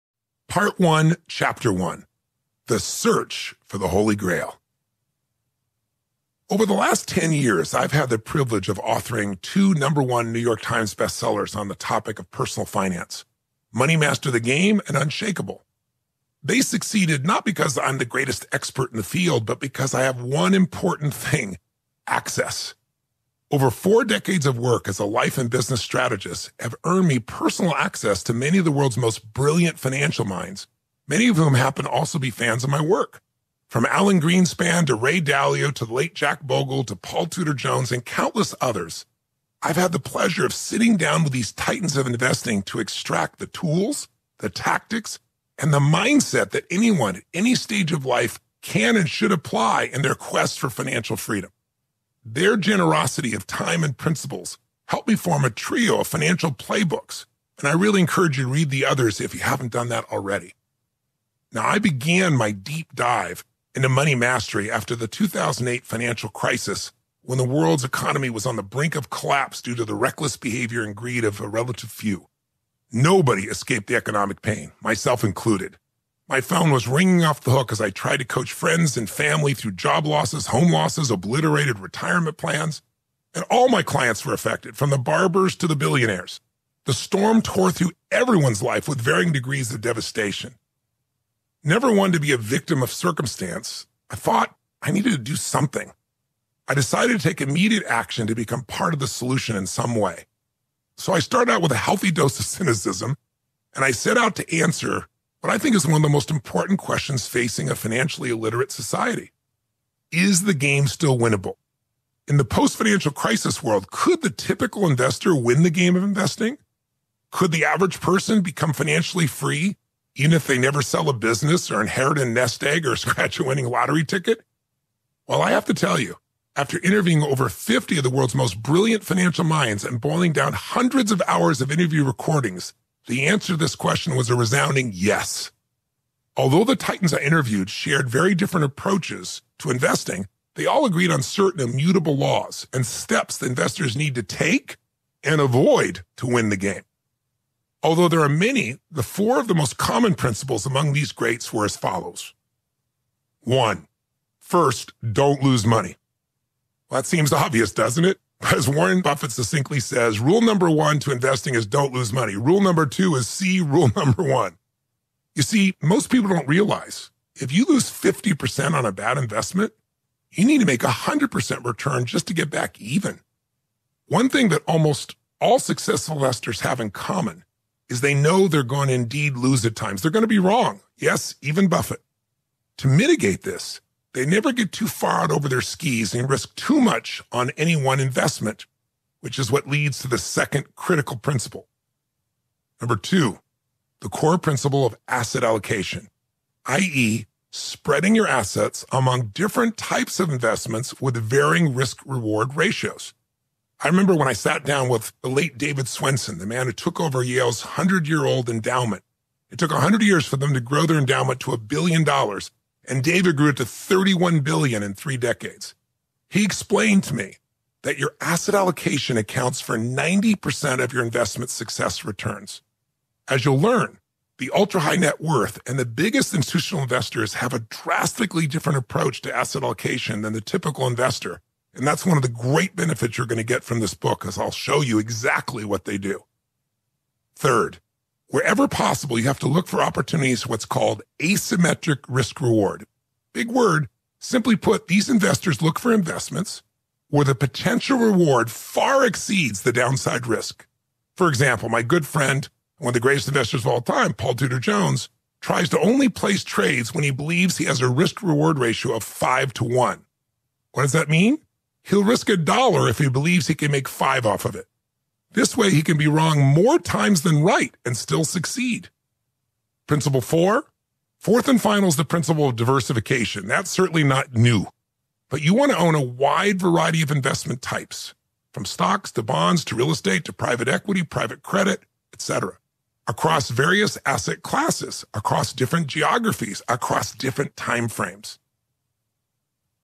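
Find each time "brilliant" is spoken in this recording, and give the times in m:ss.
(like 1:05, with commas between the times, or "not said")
0:29, 2:08.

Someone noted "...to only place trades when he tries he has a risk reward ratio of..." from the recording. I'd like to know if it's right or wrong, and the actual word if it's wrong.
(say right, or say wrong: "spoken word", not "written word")
wrong: "believes", not "tries".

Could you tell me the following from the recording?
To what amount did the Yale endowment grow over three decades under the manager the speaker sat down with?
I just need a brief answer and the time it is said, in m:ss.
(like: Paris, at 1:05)
31 billion, at 3:33.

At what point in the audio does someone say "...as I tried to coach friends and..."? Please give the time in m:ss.
1:17.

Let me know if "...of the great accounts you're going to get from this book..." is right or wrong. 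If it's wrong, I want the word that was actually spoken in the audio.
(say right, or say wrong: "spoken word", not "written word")
wrong: "benefits", not "accounts".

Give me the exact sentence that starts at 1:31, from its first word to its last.
Never one to be a victim of circumstance, I thought I needed to do something.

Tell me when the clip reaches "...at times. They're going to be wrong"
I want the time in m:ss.
2:59.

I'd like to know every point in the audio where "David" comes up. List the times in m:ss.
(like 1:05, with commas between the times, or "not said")
3:25, 3:33.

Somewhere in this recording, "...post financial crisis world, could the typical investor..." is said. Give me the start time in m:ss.
1:52.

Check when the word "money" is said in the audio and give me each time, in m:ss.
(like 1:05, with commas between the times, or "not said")
0:13, 1:03, 2:35, 2:42.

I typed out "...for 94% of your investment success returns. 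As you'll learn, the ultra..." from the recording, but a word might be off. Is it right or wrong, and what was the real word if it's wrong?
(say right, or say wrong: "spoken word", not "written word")
wrong: "90", not "94".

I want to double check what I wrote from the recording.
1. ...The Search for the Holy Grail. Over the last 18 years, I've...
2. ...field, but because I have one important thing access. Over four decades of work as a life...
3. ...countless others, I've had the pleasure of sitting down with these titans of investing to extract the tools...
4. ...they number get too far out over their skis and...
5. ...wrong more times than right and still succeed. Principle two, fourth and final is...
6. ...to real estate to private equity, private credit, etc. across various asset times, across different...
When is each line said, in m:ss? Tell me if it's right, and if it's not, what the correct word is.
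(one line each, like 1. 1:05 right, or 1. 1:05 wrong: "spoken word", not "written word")
1. 0:02 wrong: "10", not "18"
2. 0:19 right
3. 0:38 right
4. 3:04 wrong: "never", not "number"
5. 4:26 wrong: "four", not "two"
6. 4:39 wrong: "classes", not "times".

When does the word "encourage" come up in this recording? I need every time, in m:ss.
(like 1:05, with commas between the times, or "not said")
0:57.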